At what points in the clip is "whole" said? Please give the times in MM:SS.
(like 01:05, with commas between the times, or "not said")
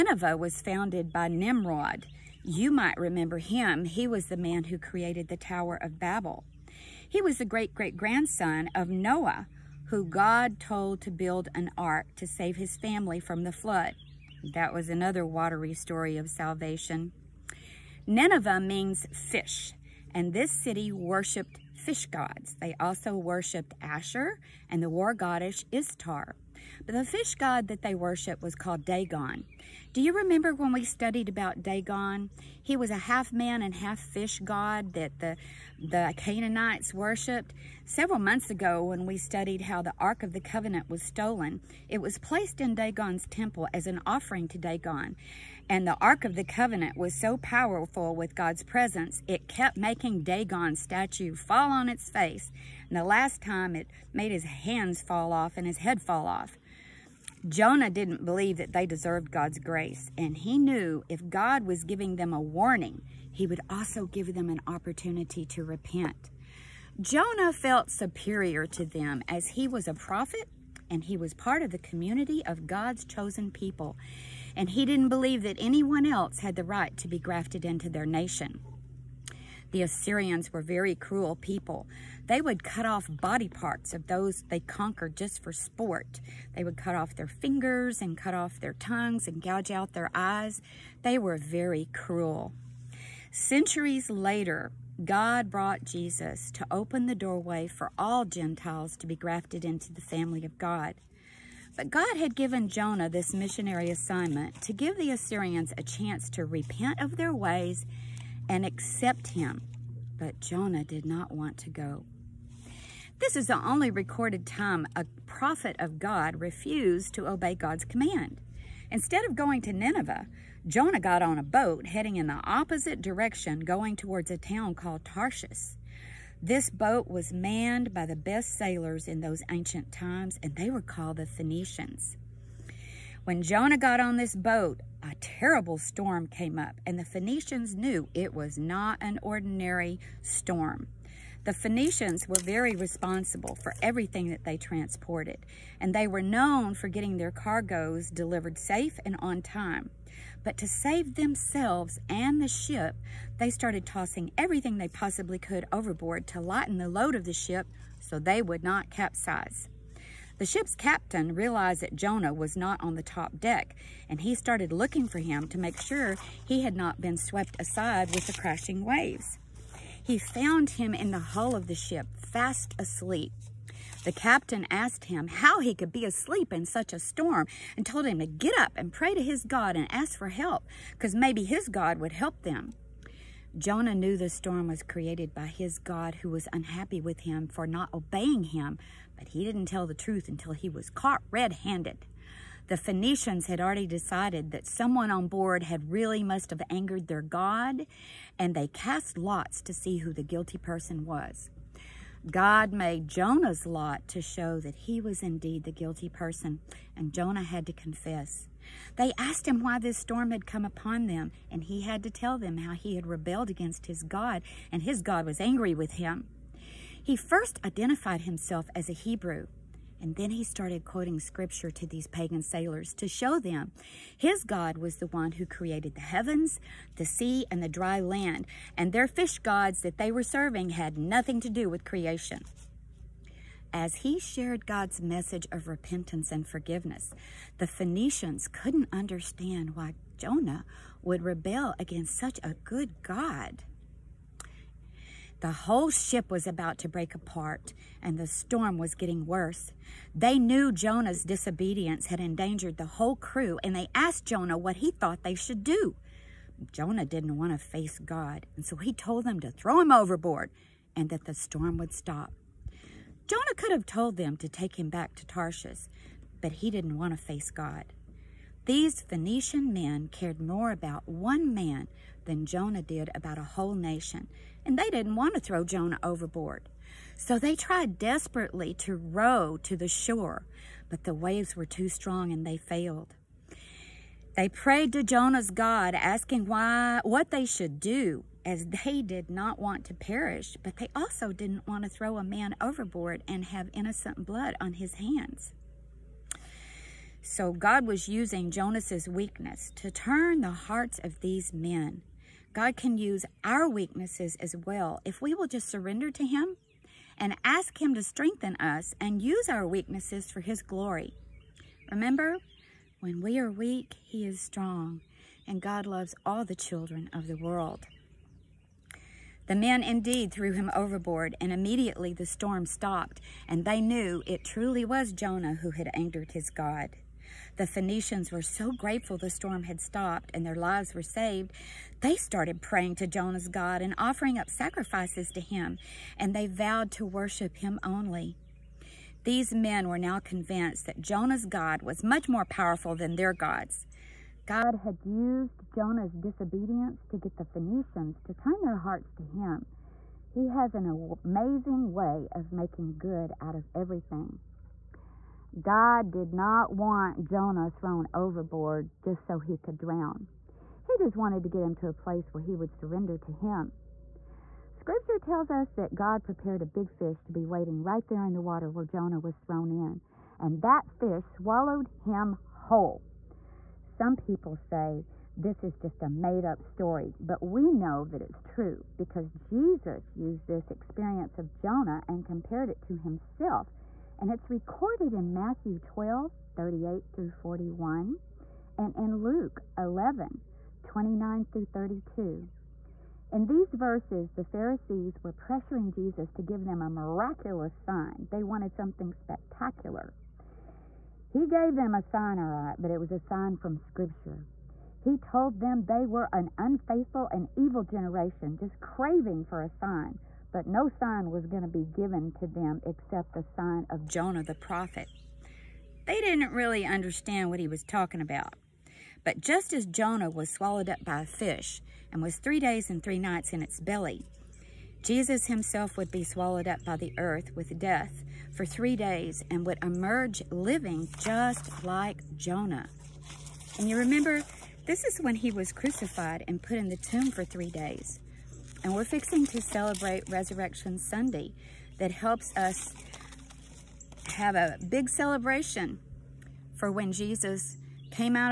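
04:05, 04:12, 04:33, 06:12.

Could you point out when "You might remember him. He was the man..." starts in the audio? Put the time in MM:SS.
00:02.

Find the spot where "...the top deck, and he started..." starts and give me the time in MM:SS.
02:42.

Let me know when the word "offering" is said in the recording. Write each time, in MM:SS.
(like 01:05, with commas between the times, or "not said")
00:44, 05:33.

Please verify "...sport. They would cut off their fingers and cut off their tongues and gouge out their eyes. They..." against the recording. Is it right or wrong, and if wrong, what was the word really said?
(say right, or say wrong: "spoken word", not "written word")
right.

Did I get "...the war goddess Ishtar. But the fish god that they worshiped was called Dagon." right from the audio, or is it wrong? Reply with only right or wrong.
right.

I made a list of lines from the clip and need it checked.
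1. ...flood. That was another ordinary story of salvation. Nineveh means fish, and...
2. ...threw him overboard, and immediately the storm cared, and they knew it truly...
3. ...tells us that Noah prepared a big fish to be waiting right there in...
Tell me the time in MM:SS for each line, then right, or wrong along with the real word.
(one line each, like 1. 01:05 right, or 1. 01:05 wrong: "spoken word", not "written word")
1. 00:13 wrong: "watery", not "ordinary"
2. 05:20 wrong: "stopped", not "cared"
3. 06:05 wrong: "God", not "Noah".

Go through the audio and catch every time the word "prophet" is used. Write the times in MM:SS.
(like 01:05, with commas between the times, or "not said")
01:09, 01:55, 06:54.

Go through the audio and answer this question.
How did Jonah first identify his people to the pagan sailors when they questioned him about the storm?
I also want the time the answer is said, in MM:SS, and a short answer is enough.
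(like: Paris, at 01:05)
As a Hebrew, at 03:38.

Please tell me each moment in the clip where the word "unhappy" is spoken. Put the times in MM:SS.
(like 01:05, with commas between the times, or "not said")
03:06.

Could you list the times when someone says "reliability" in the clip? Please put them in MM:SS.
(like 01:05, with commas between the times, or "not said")
not said.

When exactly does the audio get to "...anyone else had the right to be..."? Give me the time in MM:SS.
01:15.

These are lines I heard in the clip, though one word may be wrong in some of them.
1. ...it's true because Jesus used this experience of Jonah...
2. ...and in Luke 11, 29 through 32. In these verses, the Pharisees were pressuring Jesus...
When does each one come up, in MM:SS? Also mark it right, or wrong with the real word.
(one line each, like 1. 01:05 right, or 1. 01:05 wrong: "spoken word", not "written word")
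1. 06:18 right
2. 06:28 right.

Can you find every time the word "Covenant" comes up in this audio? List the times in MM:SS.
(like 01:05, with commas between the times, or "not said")
00:40, 00:46.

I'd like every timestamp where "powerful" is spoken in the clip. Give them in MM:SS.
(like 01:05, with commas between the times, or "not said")
00:47, 05:42.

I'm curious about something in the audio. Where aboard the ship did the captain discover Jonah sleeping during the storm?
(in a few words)
In the hull.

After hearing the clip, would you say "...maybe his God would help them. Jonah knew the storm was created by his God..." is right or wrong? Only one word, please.
right.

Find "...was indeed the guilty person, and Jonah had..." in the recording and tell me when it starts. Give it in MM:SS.
03:25.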